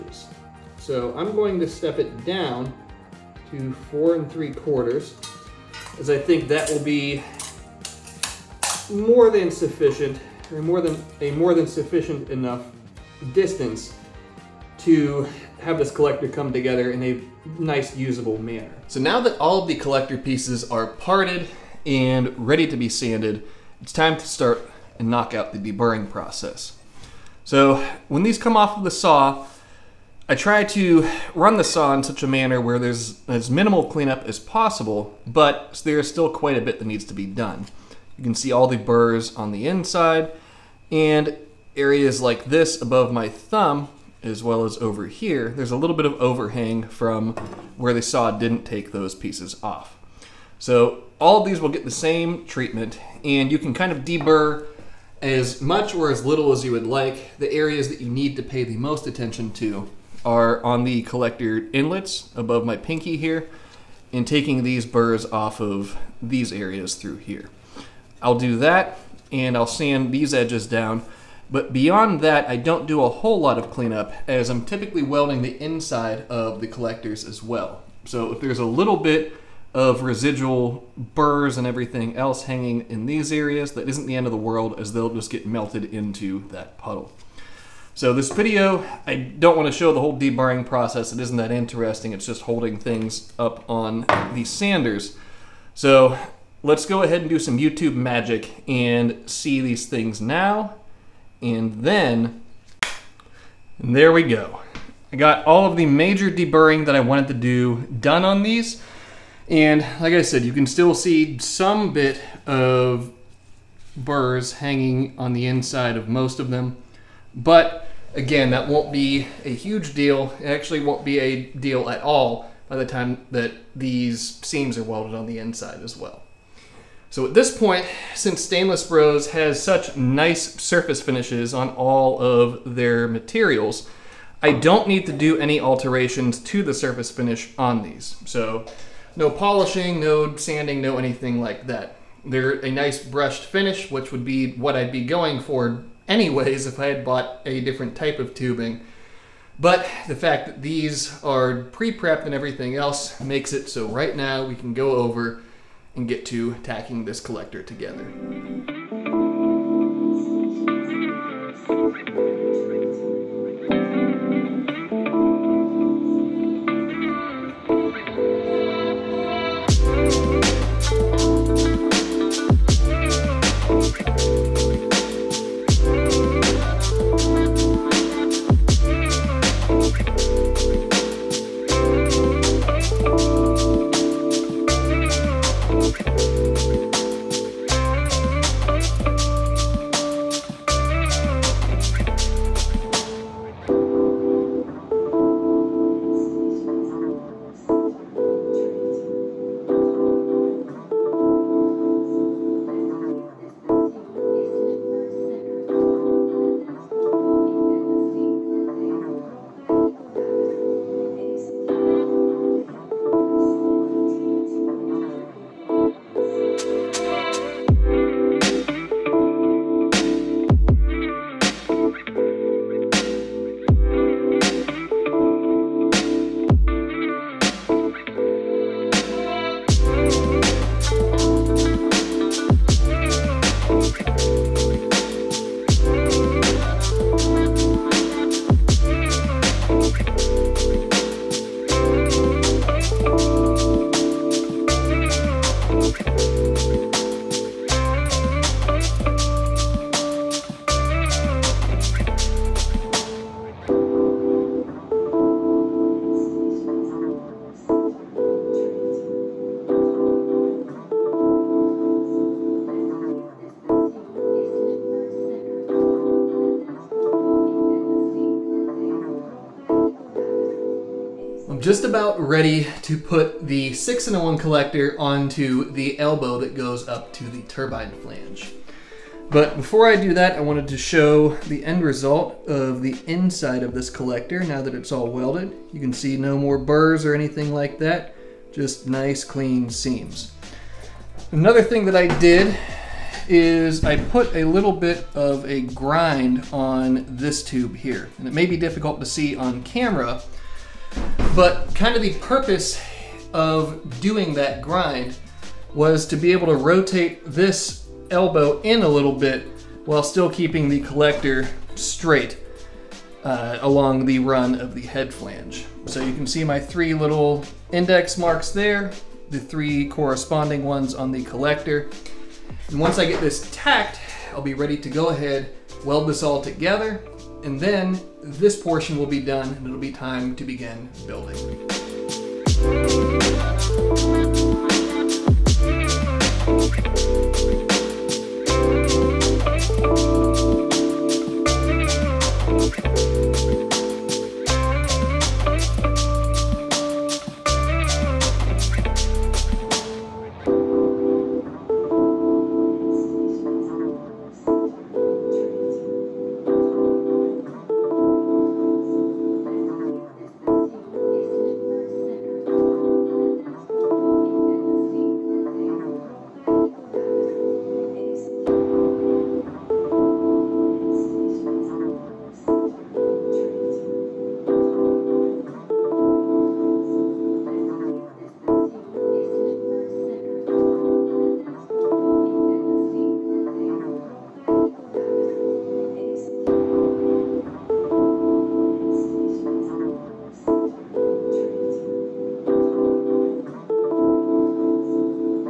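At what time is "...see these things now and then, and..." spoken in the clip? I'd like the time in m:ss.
1:39.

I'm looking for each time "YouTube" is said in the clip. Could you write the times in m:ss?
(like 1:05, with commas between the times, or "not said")
1:37.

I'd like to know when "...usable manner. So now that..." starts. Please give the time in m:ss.
0:17.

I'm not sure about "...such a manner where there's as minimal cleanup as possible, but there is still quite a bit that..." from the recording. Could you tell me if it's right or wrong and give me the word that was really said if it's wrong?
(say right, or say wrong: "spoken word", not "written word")
right.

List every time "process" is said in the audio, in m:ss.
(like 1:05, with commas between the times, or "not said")
0:26, 1:30.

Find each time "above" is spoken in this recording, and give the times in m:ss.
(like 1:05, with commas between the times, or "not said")
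0:42, 1:02.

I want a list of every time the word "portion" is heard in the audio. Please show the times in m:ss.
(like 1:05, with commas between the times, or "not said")
5:28.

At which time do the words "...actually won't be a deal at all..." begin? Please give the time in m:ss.
2:00.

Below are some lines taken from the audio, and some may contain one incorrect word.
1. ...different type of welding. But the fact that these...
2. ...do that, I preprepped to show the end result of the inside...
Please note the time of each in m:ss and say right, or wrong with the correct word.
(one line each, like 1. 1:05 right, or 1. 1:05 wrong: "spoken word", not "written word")
1. 2:27 wrong: "tubing", not "welding"
2. 4:39 wrong: "wanted", not "preprepped".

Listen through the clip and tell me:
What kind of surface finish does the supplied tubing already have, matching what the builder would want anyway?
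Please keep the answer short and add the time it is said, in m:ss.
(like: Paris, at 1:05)
brushed finish, at 2:23.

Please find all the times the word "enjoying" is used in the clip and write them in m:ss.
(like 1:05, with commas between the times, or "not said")
not said.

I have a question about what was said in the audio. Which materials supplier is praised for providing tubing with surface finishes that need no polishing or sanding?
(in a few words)
Stainless Bros.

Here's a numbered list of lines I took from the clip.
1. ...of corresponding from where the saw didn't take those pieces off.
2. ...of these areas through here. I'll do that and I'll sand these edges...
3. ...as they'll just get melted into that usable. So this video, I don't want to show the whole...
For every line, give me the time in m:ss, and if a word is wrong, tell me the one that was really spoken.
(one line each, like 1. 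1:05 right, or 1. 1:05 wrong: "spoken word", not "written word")
1. 0:46 wrong: "overhang", not "corresponding"
2. 1:05 right
3. 1:24 wrong: "puddle", not "usable".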